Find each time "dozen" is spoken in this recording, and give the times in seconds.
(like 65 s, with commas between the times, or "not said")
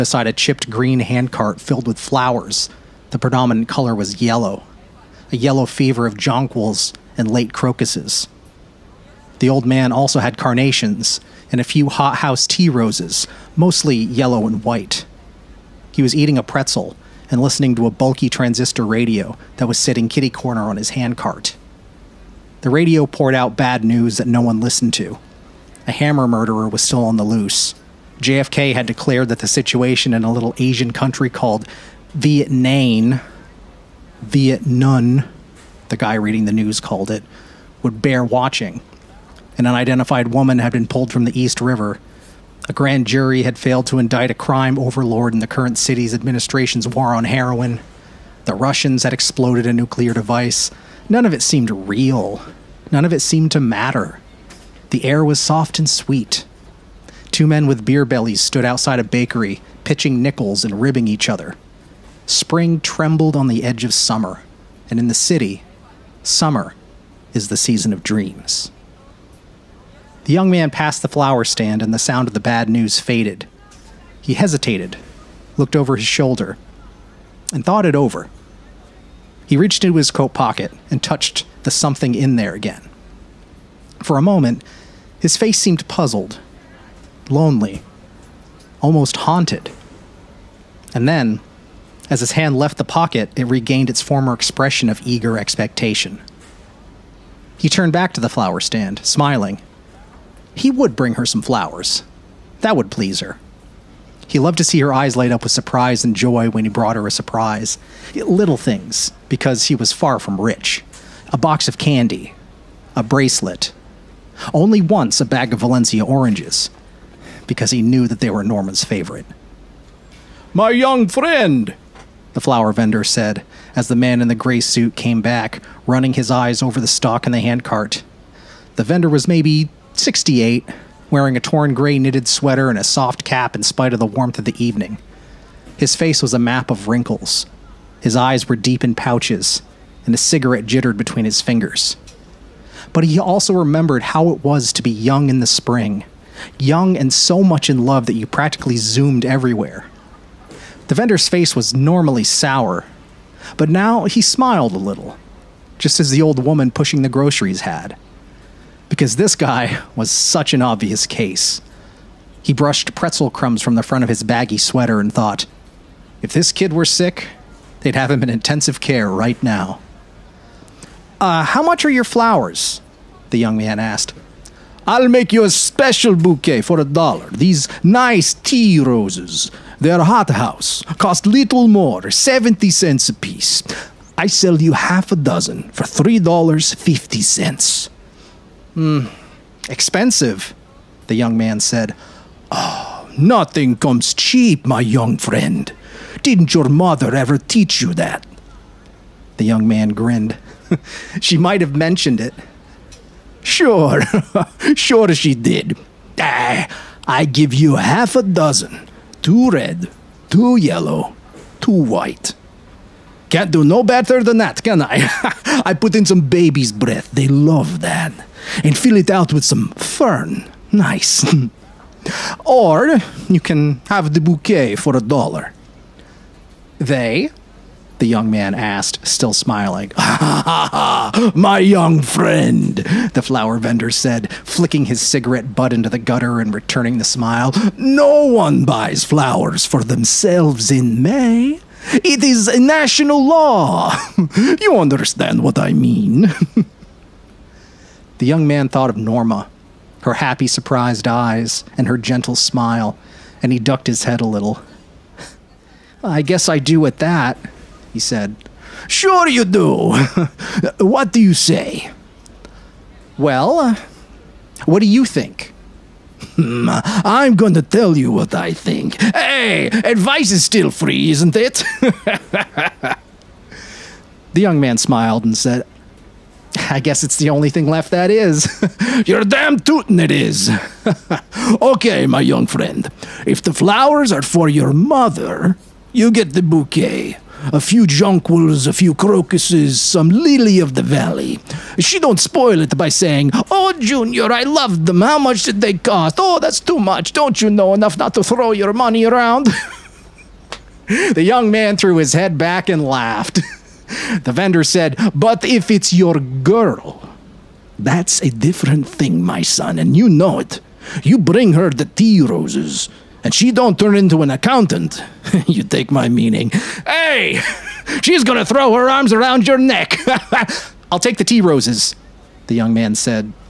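185 s, 208 s.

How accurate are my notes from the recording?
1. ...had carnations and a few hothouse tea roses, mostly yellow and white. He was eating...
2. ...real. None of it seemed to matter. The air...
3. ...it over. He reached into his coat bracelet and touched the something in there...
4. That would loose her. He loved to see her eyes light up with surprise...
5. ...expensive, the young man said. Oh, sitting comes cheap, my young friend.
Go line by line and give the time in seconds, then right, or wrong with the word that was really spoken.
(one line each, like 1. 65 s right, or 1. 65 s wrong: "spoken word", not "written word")
1. 10 s right
2. 51 s right
3. 77 s wrong: "pocket", not "bracelet"
4. 102 s wrong: "please", not "loose"
5. 189 s wrong: "nothing", not "sitting".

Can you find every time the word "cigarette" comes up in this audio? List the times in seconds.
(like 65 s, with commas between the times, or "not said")
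140 s, 235 s.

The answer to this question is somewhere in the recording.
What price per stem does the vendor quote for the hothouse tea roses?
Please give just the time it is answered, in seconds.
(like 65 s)
182 s.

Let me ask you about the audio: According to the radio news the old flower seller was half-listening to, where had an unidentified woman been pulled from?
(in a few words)
East River.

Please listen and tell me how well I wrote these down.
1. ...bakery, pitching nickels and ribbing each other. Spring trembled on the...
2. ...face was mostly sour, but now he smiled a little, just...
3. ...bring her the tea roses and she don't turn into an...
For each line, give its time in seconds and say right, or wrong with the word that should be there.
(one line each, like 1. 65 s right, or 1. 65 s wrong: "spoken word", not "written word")
1. 59 s right
2. 151 s wrong: "normally", not "mostly"
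3. 311 s right.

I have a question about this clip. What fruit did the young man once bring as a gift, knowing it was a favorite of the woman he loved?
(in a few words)
Valencia oranges.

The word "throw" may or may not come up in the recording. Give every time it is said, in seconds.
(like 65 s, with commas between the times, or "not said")
298 s, 318 s.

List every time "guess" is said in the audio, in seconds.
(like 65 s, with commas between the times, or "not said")
256 s, 276 s.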